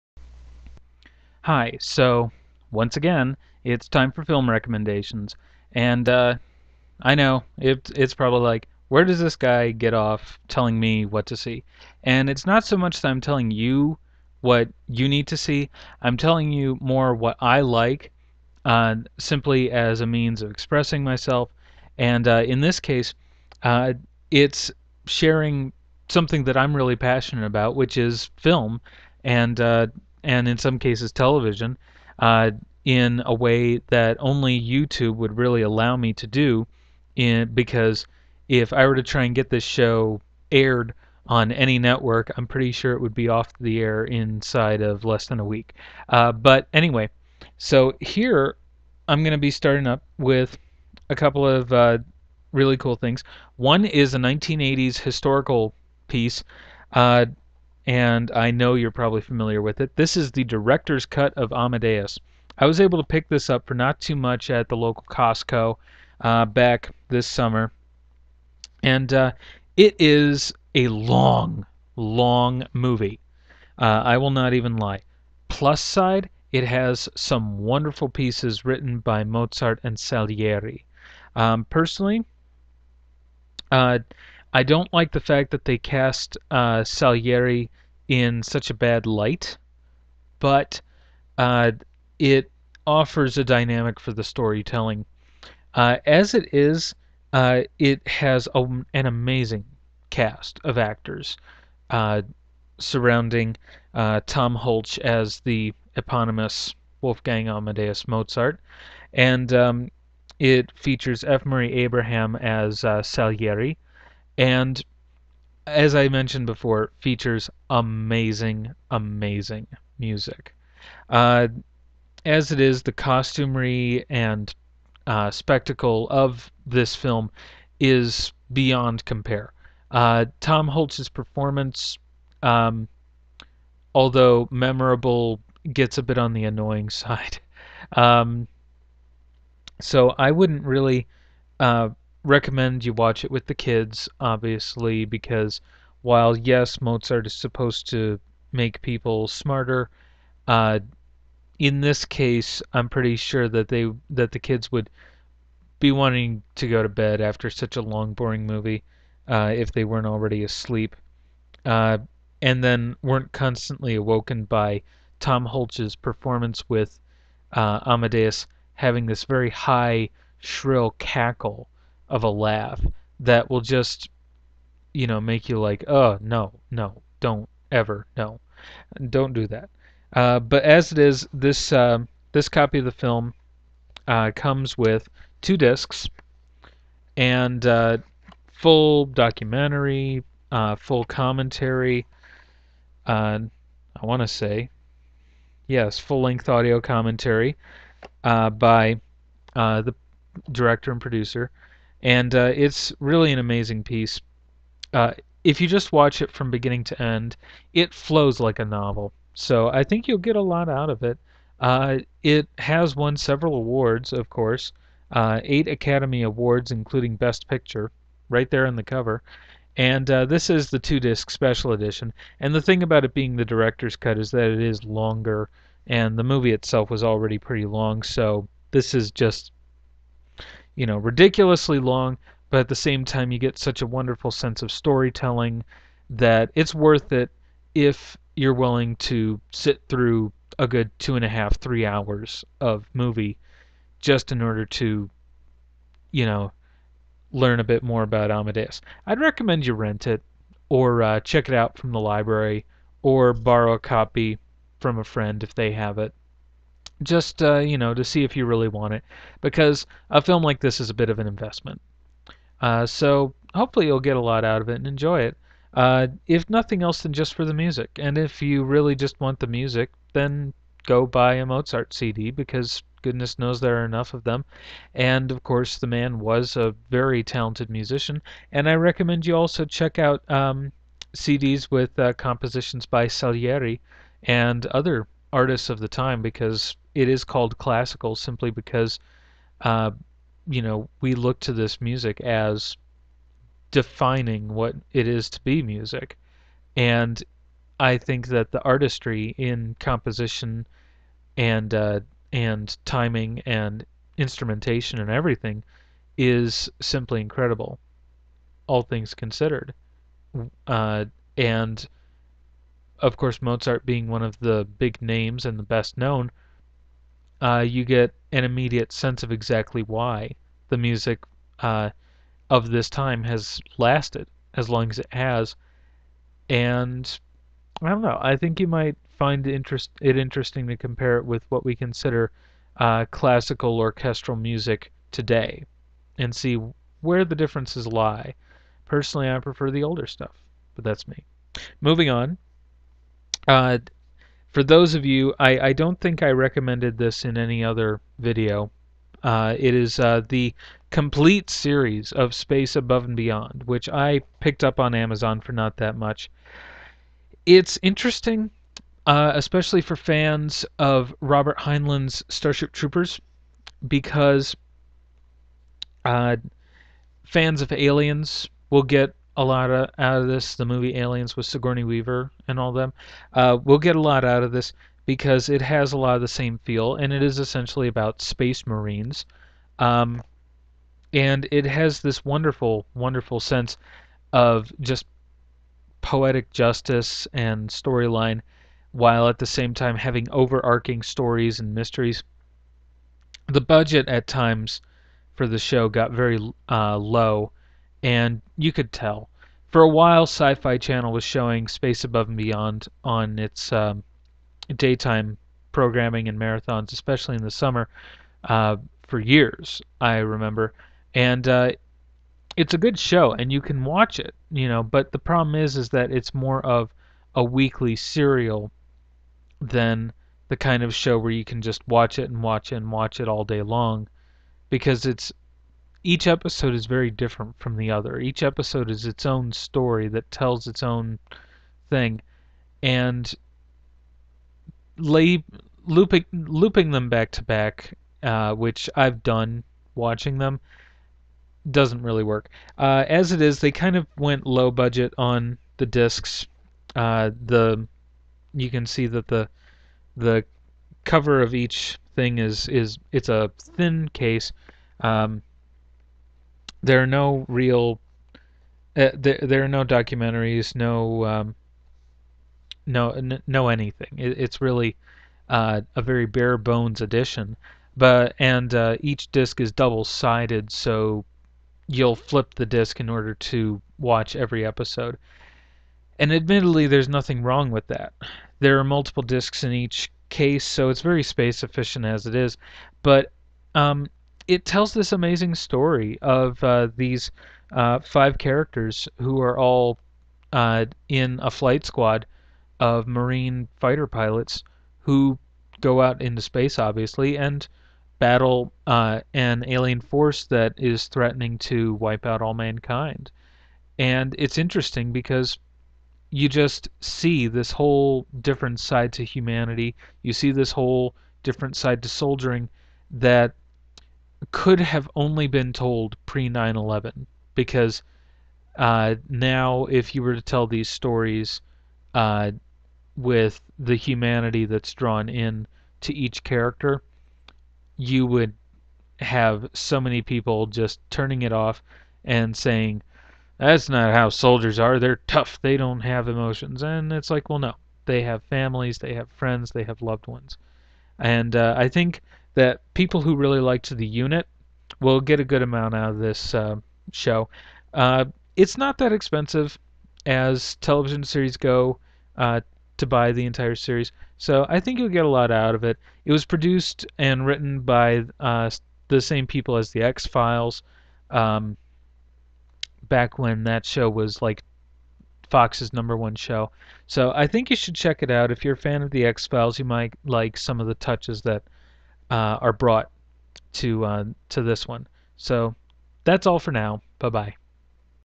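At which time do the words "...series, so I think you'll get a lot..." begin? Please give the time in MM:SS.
09:13.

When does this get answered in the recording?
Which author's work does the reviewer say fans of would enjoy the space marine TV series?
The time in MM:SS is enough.
06:01.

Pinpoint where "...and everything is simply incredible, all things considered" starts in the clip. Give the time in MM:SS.
05:04.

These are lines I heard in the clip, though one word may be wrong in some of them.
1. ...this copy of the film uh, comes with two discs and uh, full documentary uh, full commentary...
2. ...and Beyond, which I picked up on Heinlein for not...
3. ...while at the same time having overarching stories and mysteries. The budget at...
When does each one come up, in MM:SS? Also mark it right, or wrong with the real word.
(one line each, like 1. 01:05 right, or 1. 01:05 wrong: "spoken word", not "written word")
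1. 03:02 right
2. 05:53 wrong: "Amazon", not "Heinlein"
3. 06:28 right.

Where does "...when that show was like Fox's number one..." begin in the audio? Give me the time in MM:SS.
09:23.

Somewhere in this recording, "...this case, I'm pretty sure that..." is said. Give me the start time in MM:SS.
02:31.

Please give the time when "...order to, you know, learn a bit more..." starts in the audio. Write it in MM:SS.
04:04.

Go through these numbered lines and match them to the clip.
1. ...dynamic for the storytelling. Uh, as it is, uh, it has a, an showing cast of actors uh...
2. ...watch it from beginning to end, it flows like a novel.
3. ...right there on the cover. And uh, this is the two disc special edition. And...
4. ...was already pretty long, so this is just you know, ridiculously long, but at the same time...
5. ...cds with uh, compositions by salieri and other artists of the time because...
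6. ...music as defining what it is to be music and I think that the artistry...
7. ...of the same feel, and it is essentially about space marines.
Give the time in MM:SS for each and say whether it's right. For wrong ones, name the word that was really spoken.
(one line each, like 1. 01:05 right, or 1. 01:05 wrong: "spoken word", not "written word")
1. 01:33 wrong: "amazing", not "showing"
2. 03:25 right
3. 03:38 right
4. 03:46 right
5. 04:41 right
6. 04:51 right
7. 06:16 right.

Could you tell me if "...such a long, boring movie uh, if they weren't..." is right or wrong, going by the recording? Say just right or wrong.
right.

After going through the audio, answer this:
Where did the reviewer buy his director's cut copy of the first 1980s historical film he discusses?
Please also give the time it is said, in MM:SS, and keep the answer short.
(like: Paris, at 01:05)
Costco, at 01:05.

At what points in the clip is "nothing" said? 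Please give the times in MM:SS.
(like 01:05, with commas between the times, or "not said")
04:26, 07:57.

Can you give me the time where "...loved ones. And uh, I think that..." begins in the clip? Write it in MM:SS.
09:00.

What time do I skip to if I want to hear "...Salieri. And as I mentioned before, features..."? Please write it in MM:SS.
01:53.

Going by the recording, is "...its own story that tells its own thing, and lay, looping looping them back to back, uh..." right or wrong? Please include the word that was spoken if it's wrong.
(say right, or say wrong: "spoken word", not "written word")
right.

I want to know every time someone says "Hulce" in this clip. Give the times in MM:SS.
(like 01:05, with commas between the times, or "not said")
01:44, 02:10, 02:45.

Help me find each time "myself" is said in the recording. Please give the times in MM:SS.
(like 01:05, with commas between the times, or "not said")
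00:21.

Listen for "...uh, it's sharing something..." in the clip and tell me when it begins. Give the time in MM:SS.
00:23.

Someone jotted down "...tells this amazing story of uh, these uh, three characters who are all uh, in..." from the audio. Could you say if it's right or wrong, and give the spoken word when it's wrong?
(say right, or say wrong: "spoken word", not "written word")
wrong: "five", not "three".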